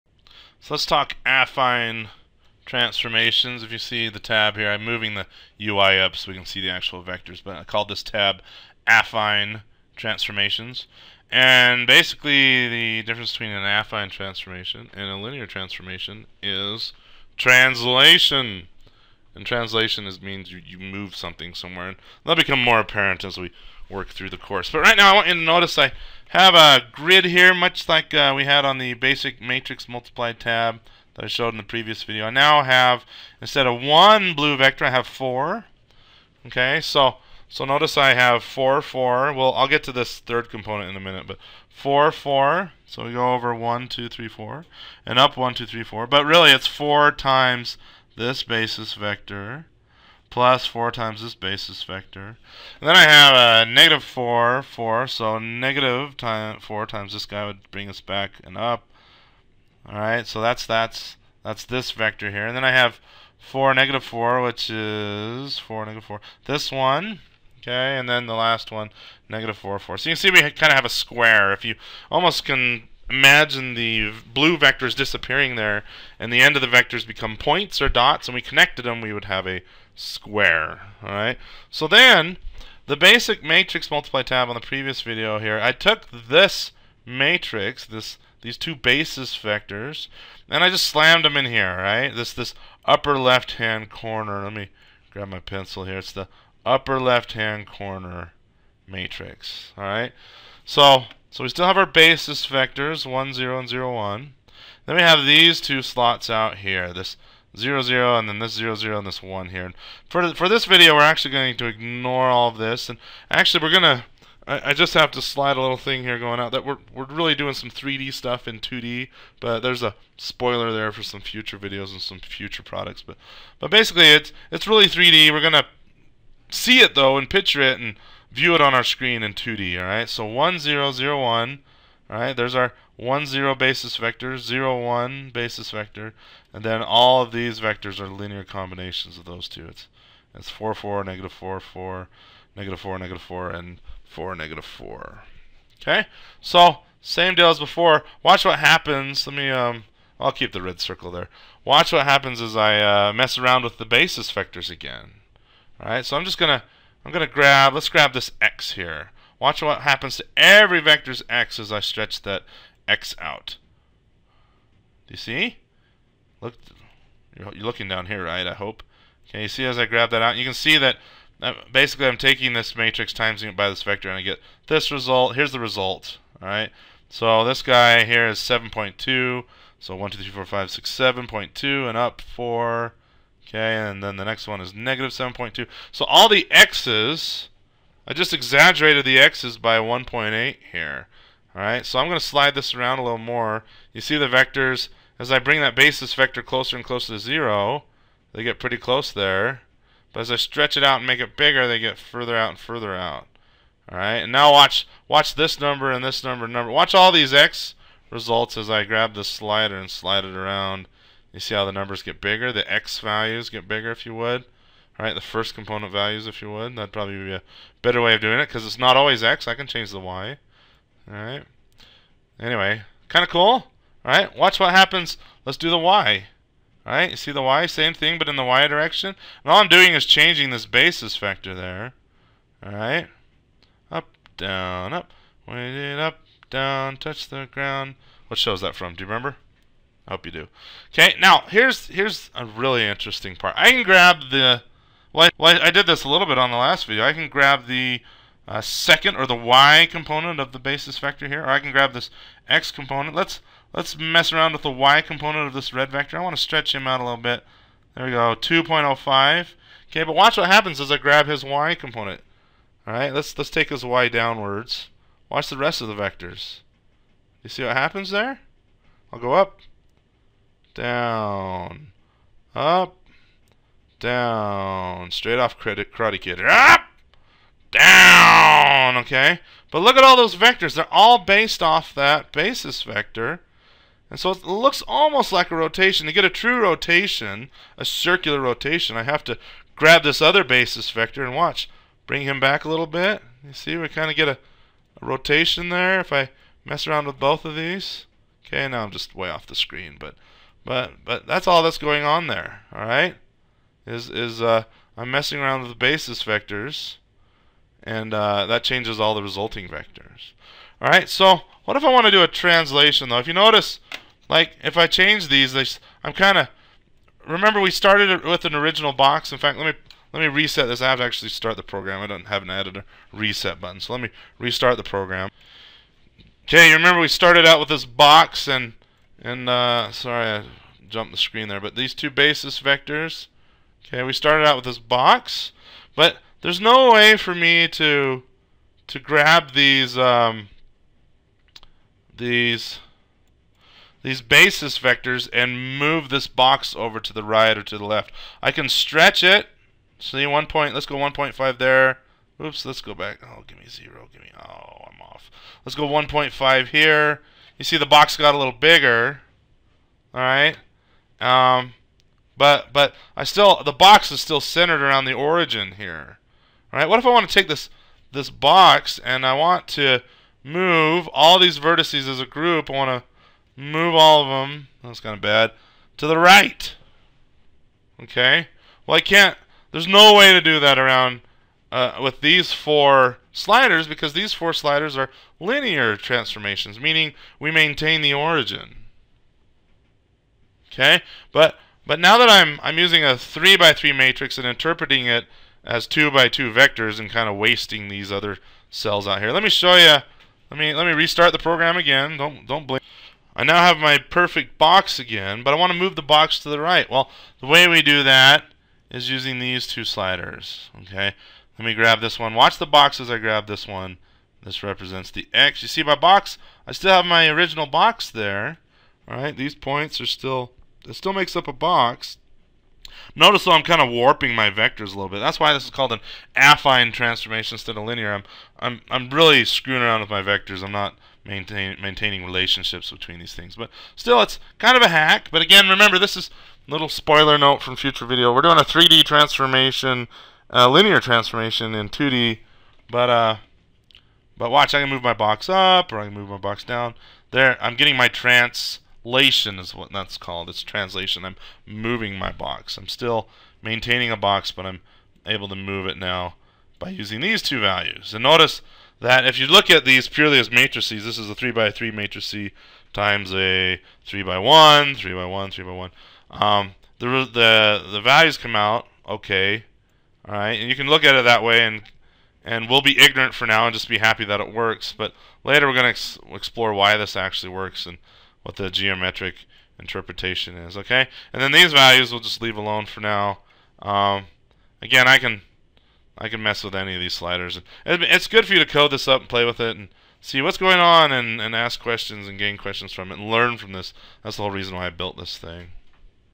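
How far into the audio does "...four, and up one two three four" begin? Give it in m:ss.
0:44.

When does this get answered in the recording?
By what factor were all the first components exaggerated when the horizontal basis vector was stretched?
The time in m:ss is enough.
3:09.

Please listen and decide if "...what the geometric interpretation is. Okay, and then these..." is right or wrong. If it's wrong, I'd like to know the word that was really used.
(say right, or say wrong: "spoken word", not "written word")
right.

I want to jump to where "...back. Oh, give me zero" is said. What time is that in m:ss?
5:52.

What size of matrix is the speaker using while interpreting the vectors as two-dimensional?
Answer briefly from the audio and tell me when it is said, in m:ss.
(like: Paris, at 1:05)
3 by 3, at 6:33.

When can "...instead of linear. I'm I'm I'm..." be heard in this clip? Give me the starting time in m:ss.
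7:07.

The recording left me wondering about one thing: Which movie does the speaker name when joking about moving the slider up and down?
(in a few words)
Karate Kid.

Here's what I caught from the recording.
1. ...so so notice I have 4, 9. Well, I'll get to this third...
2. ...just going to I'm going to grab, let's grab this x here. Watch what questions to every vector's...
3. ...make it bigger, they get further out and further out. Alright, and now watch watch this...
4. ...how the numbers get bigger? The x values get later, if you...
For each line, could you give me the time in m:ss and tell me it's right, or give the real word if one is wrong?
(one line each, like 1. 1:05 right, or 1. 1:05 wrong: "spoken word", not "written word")
1. 0:36 wrong: "4", not "9"
2. 2:36 wrong: "happens", not "questions"
3. 3:21 right
4. 3:31 wrong: "bigger", not "later".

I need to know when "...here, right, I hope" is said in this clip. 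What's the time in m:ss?
2:48.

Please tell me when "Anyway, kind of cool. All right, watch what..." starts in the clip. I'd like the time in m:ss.
3:42.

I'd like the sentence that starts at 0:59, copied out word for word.
Alright, so that's that's that's this vector here.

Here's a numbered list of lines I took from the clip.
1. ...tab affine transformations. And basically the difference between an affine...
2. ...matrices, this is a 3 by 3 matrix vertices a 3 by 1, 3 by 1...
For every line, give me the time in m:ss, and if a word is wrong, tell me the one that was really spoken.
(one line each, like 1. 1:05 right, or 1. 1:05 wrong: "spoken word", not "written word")
1. 0:08 right
2. 7:40 wrong: "times", not "vertices".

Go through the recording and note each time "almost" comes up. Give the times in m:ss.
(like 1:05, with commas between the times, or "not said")
1:12, 4:44.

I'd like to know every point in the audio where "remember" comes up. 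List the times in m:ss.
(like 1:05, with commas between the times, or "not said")
3:59, 5:17, 5:26, 7:15.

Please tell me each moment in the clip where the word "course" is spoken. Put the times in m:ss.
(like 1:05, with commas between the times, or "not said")
0:24.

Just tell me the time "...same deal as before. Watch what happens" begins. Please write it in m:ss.
2:27.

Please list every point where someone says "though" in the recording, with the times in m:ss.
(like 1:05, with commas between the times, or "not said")
2:06, 5:13, 7:03.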